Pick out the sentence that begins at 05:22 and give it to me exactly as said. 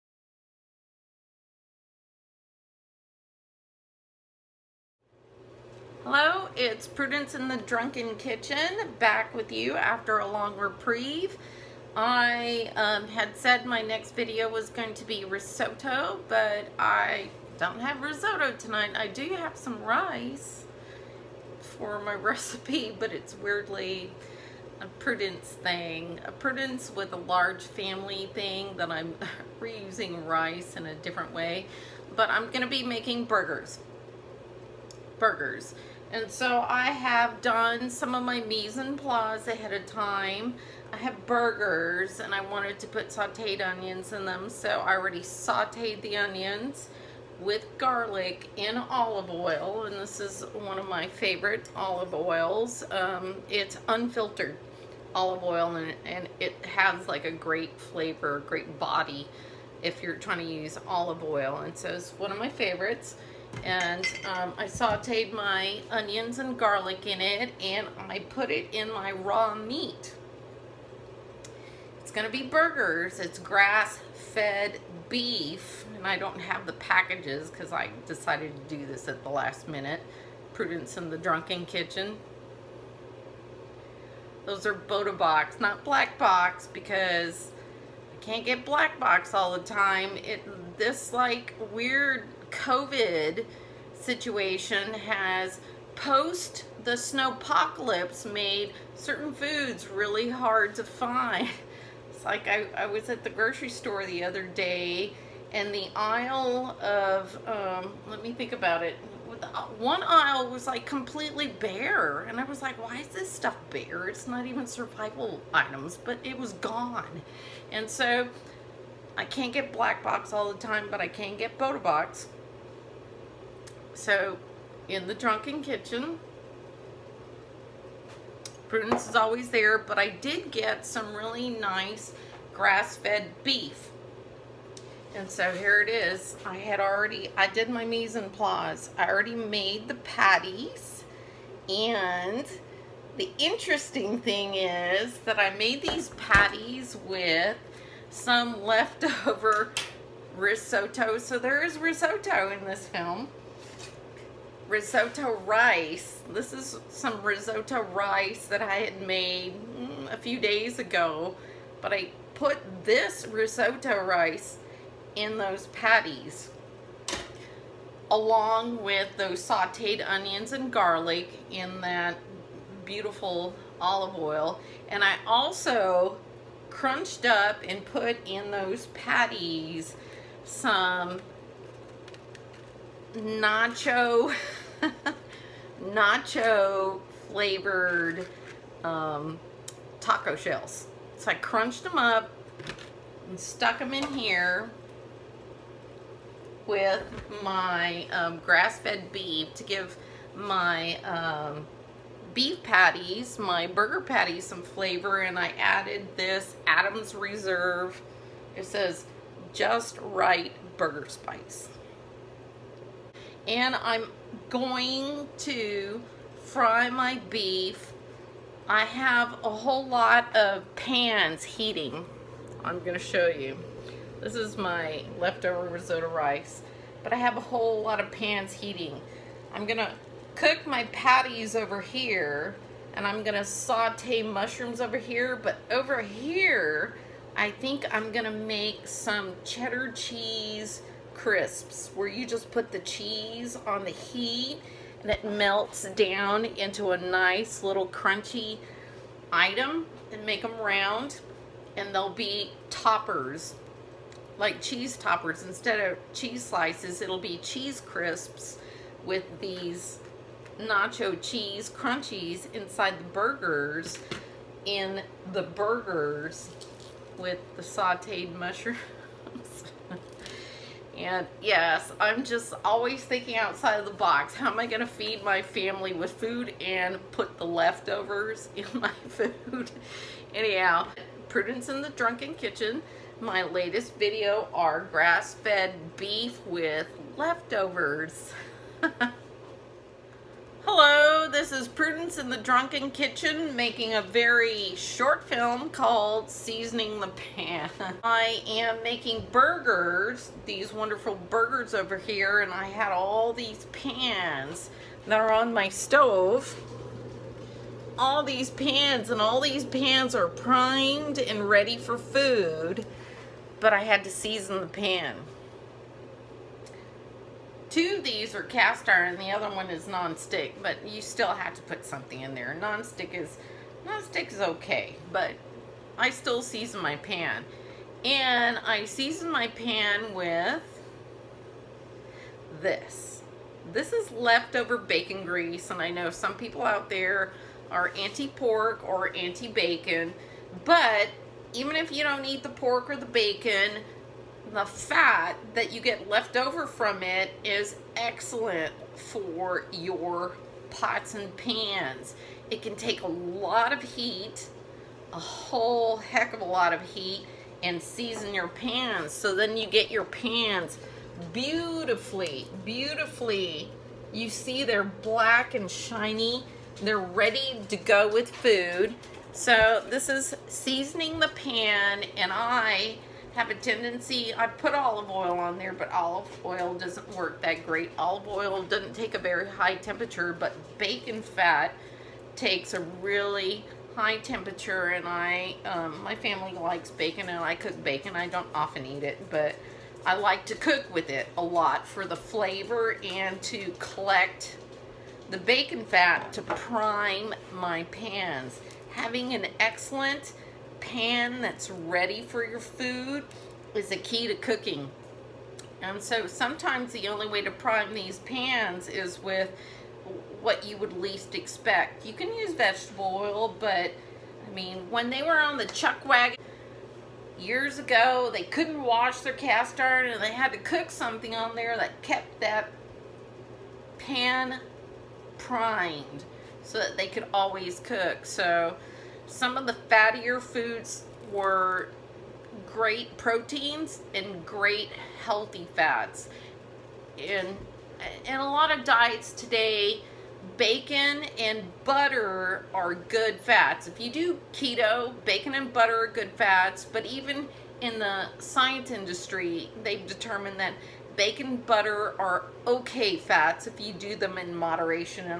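Nonstick is nonstick is okay, but I still season my pan.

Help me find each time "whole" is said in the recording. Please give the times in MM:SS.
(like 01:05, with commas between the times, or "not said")
03:39, 03:47, 05:55.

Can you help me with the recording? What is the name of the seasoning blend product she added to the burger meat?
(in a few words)
Adams Reserve.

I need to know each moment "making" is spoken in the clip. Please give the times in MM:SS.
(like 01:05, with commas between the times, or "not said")
00:32, 04:53, 04:58.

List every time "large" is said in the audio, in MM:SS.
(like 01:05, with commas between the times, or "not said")
00:27.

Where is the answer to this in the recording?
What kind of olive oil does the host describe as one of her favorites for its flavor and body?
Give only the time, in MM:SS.
00:53.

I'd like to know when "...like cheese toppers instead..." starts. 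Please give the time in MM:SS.
04:14.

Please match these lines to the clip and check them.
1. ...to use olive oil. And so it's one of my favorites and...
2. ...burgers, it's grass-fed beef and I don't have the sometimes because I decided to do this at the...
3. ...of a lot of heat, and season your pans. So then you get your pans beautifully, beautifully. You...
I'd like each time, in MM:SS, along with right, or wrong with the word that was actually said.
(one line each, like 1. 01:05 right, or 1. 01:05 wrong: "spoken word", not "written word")
1. 01:00 right
2. 01:12 wrong: "packages", not "sometimes"
3. 05:56 right.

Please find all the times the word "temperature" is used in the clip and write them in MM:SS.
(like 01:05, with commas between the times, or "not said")
06:19, 06:24.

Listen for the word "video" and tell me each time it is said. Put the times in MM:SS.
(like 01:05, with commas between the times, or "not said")
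00:14, 04:43.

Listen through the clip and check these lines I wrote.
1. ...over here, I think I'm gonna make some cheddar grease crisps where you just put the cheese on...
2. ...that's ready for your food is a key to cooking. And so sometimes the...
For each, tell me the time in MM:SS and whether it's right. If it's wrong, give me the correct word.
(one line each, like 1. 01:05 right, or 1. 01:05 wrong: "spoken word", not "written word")
1. 03:55 wrong: "cheese", not "grease"
2. 06:41 right.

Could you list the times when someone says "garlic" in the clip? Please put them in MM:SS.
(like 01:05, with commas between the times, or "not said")
00:47, 01:06, 02:50.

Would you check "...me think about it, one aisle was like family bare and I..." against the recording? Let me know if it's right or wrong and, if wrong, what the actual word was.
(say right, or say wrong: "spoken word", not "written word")
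wrong: "completely", not "family".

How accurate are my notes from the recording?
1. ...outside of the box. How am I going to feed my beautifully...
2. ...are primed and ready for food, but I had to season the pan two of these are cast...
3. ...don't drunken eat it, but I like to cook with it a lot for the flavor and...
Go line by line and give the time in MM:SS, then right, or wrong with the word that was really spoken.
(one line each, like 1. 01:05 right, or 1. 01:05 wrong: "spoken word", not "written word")
1. 04:33 wrong: "family", not "beautifully"
2. 05:10 right
3. 06:28 wrong: "often", not "drunken".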